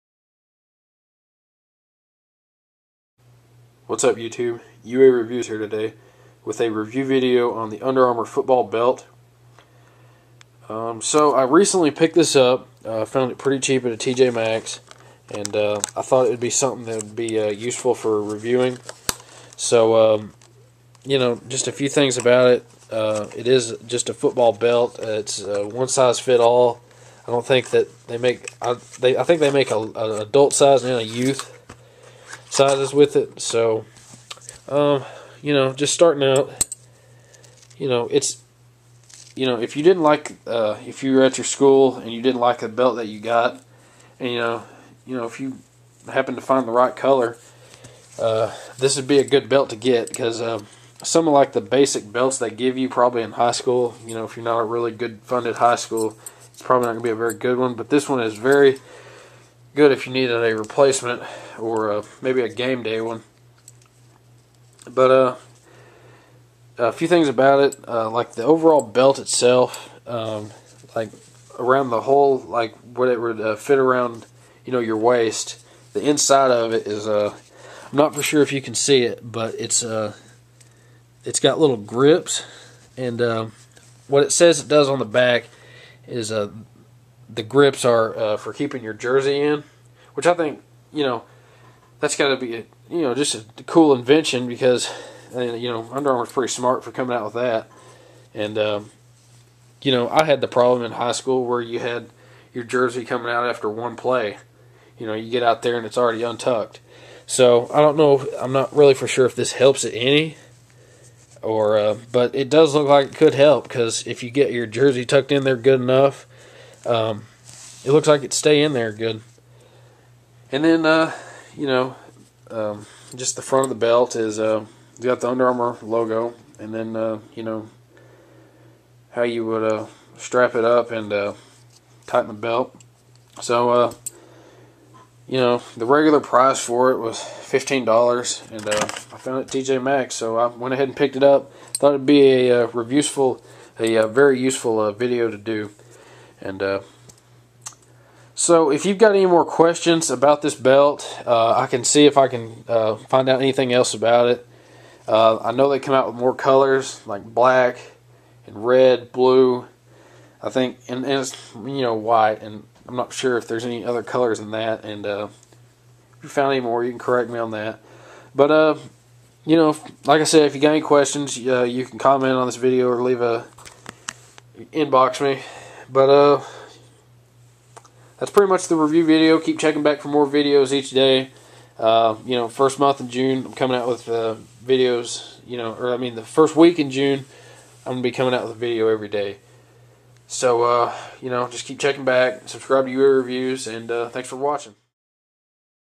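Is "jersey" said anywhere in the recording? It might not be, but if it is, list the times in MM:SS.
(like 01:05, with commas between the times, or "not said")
01:28, 01:42, 01:54.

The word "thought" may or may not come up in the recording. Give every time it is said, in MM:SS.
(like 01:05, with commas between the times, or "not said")
00:16, 02:21.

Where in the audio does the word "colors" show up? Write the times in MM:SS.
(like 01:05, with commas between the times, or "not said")
00:46, 02:36, 02:44.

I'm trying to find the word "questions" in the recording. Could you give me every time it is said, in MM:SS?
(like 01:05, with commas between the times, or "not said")
02:29, 02:50.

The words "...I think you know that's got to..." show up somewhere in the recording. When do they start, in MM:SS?
01:30.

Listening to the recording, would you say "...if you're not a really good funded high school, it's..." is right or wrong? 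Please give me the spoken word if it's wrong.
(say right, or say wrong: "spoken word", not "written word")
right.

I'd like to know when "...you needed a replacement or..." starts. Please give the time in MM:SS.
01:00.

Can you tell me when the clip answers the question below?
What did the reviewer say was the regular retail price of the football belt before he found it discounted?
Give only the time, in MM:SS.
02:17.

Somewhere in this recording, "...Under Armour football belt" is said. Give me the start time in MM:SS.
00:07.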